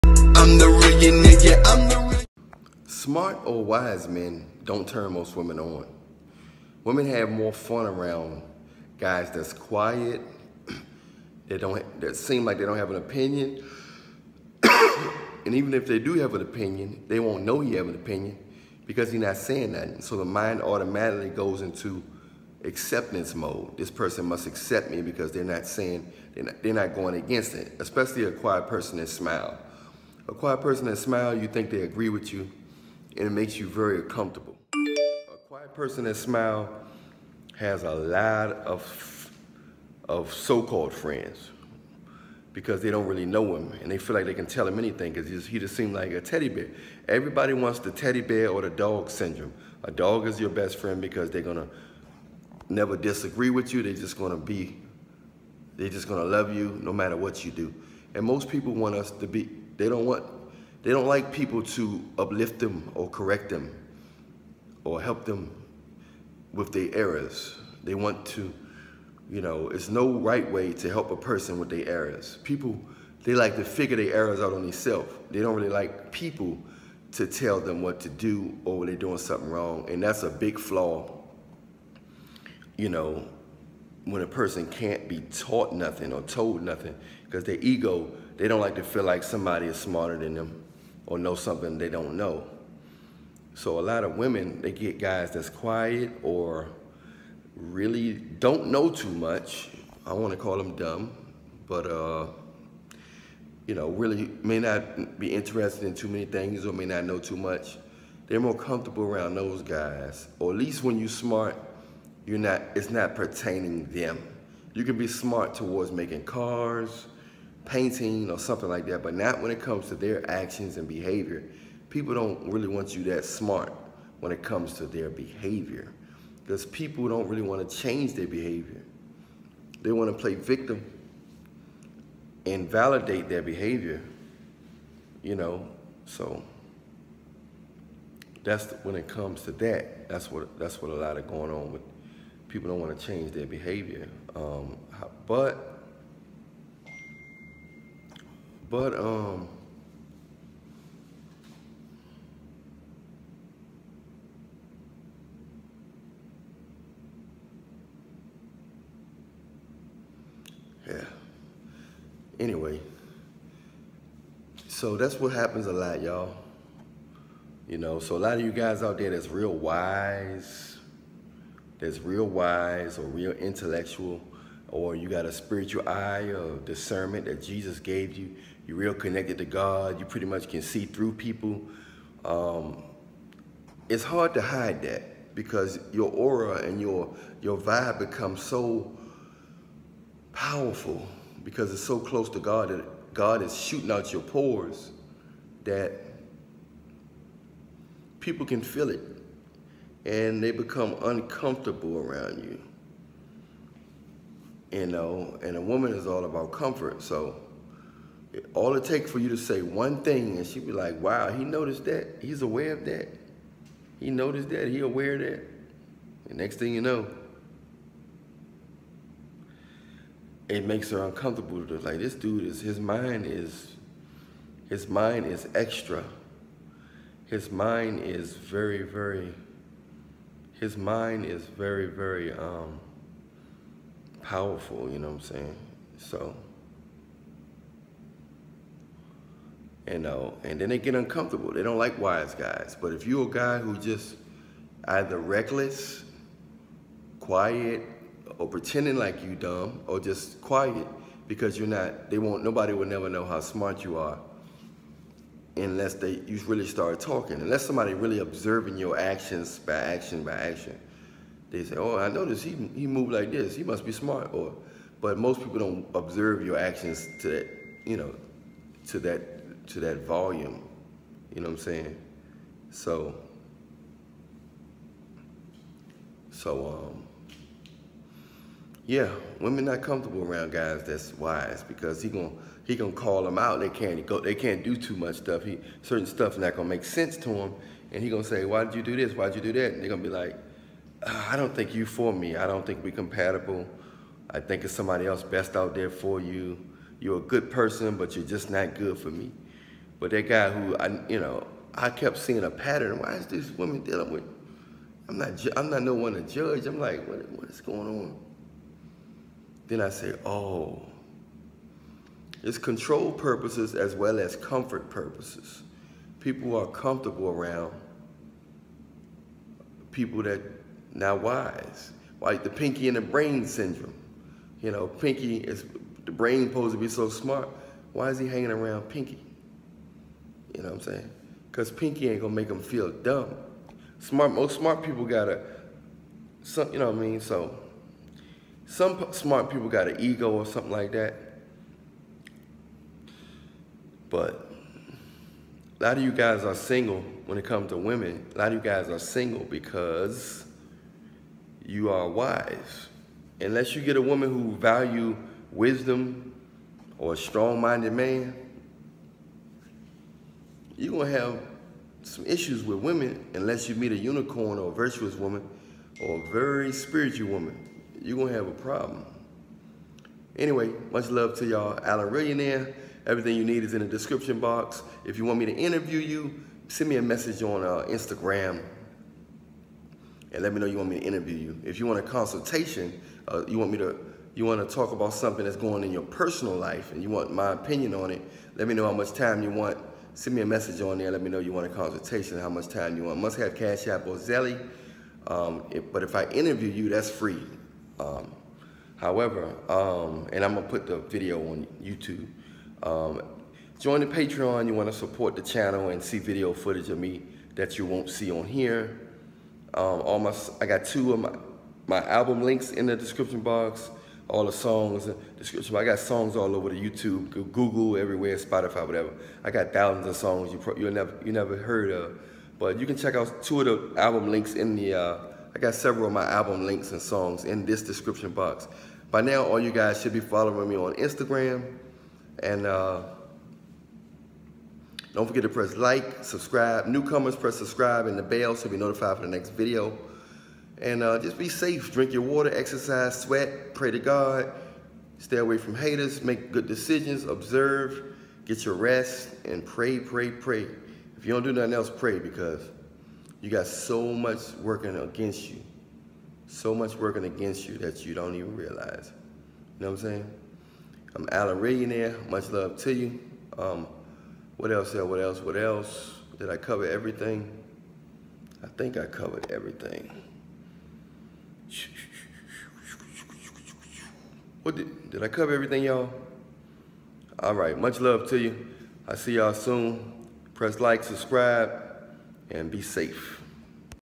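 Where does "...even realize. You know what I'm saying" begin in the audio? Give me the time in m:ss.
7:38.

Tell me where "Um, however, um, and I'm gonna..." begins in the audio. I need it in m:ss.
6:37.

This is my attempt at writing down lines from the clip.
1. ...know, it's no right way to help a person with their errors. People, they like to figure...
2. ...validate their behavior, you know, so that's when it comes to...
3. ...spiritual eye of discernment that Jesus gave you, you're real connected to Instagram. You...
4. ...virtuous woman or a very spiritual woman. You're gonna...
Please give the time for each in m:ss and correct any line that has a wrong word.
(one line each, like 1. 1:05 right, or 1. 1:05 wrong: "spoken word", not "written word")
1. 1:09 right
2. 2:12 right
3. 2:55 wrong: "God", not "Instagram"
4. 6:04 right.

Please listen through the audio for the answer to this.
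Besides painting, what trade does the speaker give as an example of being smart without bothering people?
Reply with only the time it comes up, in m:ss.
1:55.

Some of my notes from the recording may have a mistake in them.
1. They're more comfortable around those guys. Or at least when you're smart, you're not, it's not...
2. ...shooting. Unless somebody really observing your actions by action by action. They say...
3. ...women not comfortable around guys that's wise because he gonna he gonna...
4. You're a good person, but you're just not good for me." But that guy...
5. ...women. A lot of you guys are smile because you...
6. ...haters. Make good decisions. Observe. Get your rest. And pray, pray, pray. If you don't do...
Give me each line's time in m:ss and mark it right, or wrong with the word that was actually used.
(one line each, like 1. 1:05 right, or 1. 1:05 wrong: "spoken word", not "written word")
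1. 1:48 right
2. 4:16 wrong: "talking", not "shooting"
3. 4:39 right
4. 4:56 right
5. 5:47 wrong: "single", not "smile"
6. 7:25 right.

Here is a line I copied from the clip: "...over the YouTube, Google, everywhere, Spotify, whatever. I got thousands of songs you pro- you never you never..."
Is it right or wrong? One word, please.
right.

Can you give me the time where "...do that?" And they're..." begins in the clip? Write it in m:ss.
4:49.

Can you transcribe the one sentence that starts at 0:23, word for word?
This person must accept me because they're not saying, they're not, they're not going against it, especially a quiet person that smile.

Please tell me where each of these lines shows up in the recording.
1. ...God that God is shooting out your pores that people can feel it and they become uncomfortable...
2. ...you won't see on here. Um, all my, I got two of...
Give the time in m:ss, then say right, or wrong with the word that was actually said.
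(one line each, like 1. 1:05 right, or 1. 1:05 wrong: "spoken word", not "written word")
1. 3:12 right
2. 6:47 right.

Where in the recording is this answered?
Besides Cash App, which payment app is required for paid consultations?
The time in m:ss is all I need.
6:34.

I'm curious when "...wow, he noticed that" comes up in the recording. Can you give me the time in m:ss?
3:31.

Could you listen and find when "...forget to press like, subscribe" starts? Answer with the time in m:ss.
7:15.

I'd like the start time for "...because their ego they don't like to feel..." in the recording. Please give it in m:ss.
1:27.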